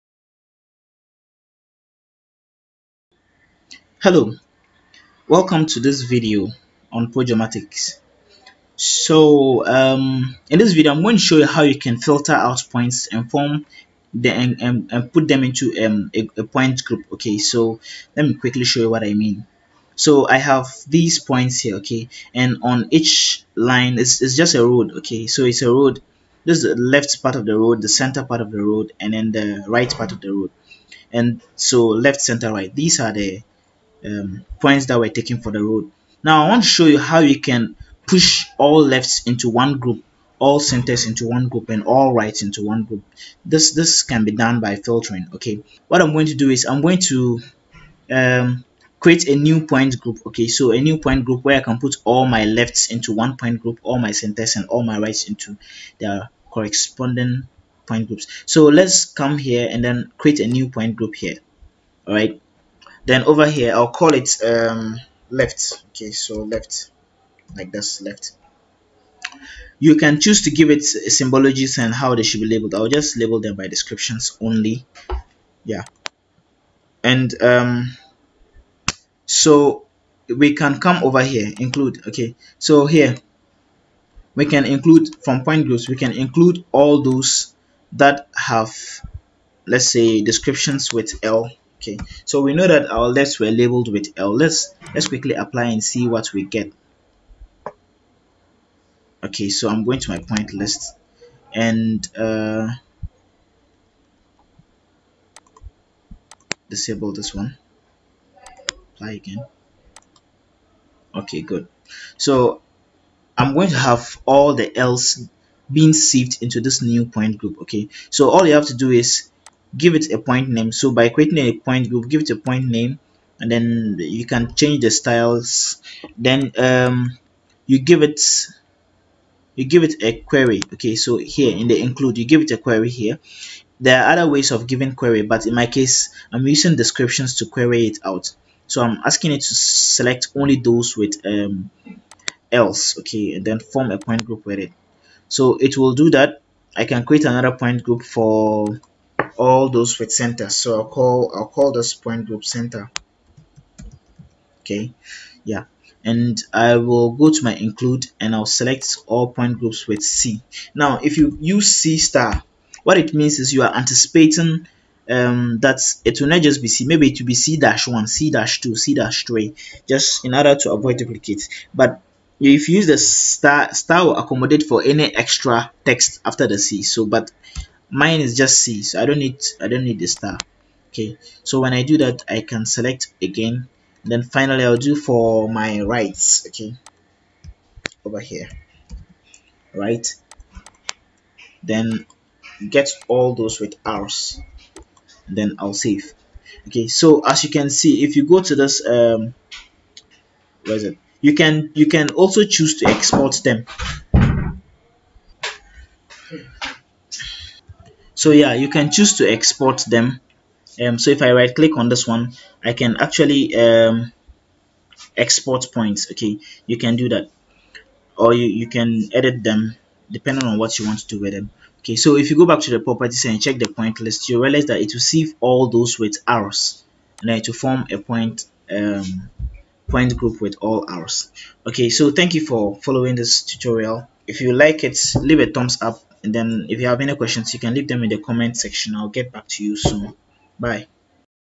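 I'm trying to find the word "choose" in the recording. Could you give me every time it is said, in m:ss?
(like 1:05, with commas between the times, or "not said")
1:10, 3:22, 3:28.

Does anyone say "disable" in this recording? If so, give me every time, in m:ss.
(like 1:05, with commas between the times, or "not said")
1:46.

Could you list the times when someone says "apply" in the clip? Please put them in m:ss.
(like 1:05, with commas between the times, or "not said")
1:35, 1:48.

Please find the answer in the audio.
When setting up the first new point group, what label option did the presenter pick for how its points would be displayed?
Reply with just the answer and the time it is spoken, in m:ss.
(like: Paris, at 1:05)
Descriptions only, at 1:13.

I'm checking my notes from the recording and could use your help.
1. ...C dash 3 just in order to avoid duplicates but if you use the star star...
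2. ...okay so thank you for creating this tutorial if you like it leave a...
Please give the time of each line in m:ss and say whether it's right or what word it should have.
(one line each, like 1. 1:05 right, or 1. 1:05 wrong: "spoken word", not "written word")
1. 2:48 right
2. 3:51 wrong: "following", not "creating".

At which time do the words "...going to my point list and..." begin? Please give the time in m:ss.
1:39.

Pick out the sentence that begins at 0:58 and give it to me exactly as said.
So let's come here and then create a new point group here.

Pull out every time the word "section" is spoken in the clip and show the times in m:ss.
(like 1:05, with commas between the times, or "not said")
3:58.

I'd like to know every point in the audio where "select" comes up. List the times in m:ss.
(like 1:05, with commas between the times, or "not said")
2:19, 2:38, 3:02.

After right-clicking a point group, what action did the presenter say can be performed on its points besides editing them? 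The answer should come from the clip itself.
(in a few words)
Export points.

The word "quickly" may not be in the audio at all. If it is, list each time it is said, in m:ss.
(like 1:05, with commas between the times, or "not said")
0:18, 1:35.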